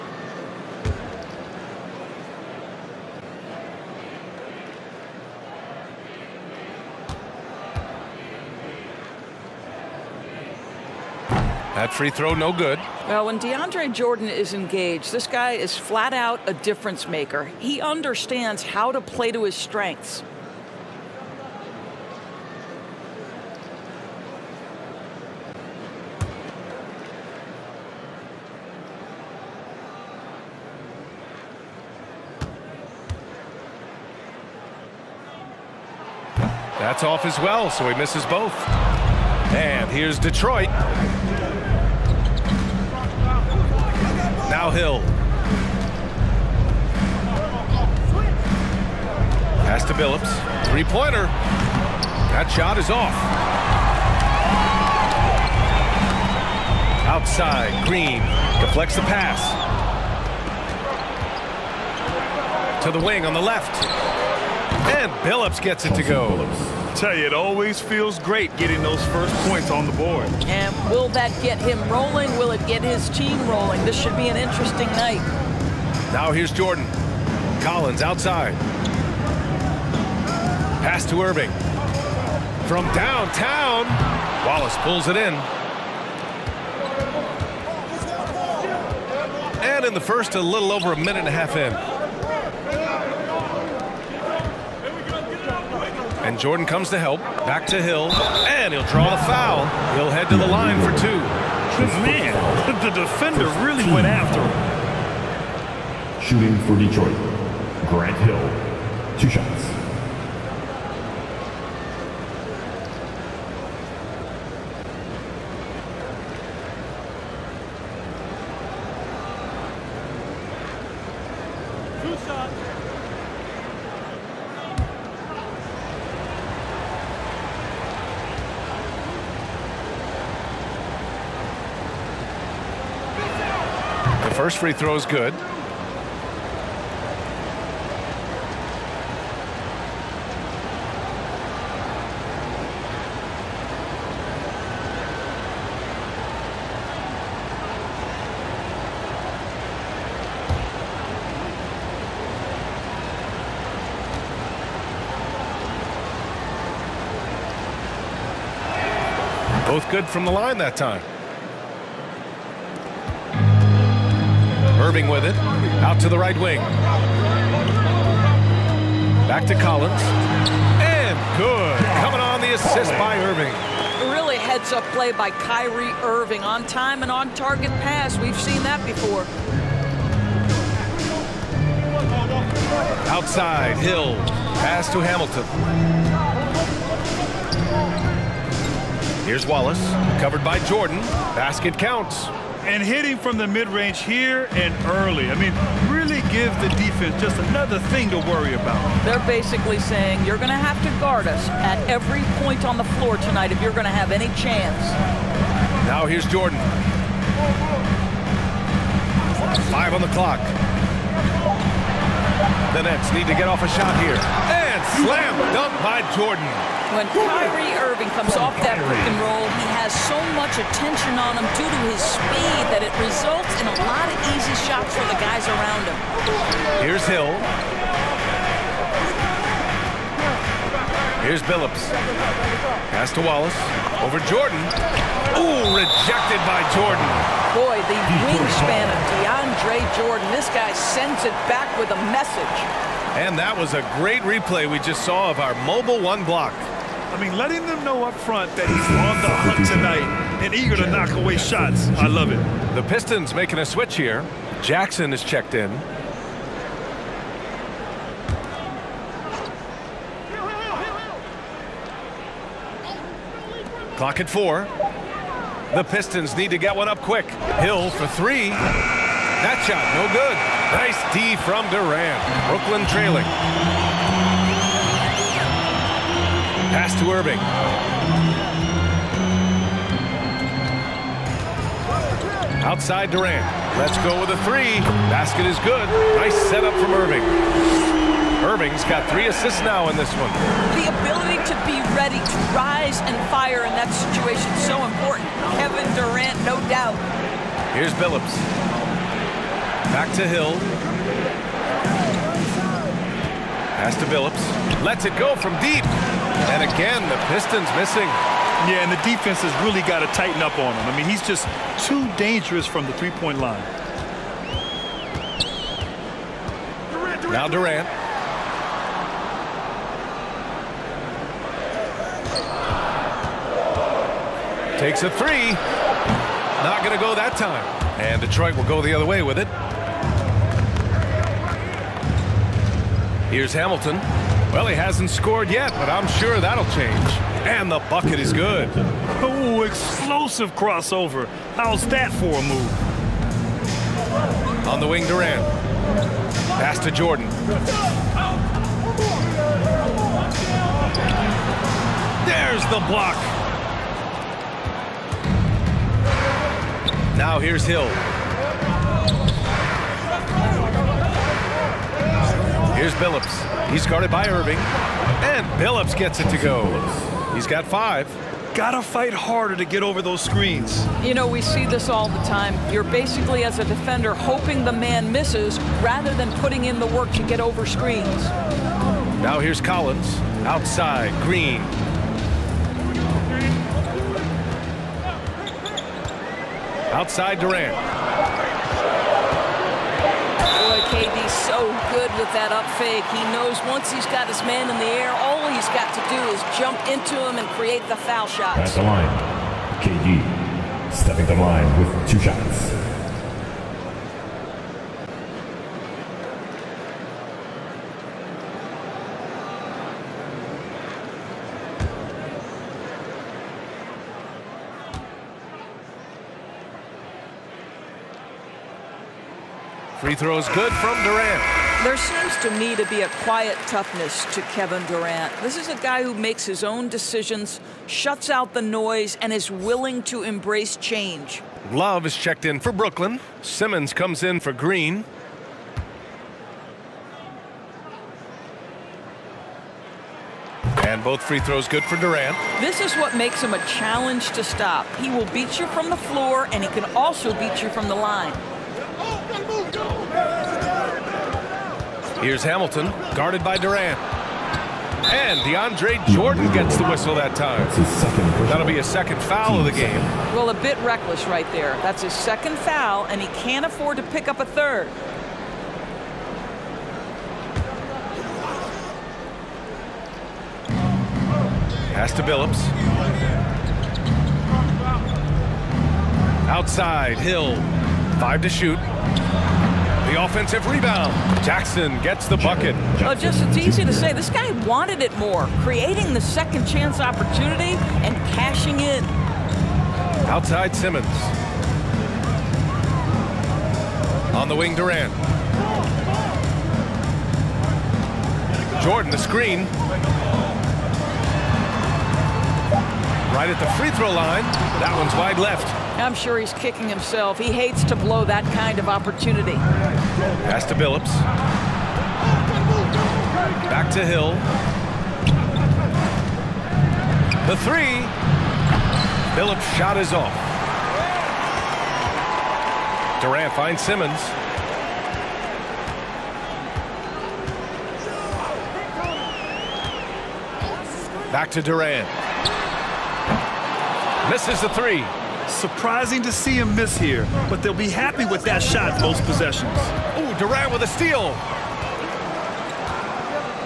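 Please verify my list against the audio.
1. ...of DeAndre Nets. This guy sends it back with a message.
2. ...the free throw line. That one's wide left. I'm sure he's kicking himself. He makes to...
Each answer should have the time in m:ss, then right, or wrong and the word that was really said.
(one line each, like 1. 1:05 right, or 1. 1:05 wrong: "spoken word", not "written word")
1. 3:58 wrong: "Jordan", not "Nets"
2. 8:23 wrong: "hates", not "makes".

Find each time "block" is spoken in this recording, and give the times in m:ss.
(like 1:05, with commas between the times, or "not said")
4:06, 5:52.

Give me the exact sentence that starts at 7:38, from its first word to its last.
That'll be a second foul of the game.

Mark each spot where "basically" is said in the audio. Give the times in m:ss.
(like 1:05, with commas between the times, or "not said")
3:19, 6:12.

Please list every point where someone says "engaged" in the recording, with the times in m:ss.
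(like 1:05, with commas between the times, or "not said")
0:14.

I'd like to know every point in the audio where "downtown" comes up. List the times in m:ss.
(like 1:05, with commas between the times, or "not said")
1:22.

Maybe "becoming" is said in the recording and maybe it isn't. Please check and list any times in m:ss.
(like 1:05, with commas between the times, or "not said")
not said.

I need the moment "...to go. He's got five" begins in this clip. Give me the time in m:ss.
6:06.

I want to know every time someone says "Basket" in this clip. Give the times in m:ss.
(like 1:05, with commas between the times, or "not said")
3:11, 4:45.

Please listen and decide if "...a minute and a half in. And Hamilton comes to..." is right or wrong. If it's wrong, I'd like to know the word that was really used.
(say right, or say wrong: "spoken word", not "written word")
wrong: "Jordan", not "Hamilton".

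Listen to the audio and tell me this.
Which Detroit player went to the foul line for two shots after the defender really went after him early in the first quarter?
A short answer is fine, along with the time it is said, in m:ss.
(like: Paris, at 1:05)
Grant Hill, at 1:47.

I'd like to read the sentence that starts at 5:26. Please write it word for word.
Not going to go that time.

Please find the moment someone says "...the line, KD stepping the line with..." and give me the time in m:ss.
6:38.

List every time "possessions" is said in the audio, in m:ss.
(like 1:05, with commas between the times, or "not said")
8:59.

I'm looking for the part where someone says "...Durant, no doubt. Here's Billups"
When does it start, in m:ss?
4:55.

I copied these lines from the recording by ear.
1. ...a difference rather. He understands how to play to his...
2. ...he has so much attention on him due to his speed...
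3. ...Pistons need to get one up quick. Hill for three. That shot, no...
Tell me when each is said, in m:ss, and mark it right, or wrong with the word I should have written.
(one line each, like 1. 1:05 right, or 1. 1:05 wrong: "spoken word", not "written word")
1. 0:16 wrong: "maker", not "rather"
2. 3:39 right
3. 4:25 right.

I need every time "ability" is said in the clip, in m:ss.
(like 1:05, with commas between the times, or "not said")
4:51.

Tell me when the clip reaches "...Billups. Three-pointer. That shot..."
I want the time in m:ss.
0:49.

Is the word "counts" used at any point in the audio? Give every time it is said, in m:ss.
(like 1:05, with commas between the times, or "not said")
3:11.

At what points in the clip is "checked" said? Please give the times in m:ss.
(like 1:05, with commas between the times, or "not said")
4:15, 7:12.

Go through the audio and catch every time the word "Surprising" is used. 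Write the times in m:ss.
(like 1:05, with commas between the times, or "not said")
8:55.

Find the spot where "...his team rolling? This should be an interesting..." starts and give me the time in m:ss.
1:12.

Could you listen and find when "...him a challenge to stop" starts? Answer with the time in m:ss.
7:23.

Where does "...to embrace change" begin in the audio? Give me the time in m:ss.
7:10.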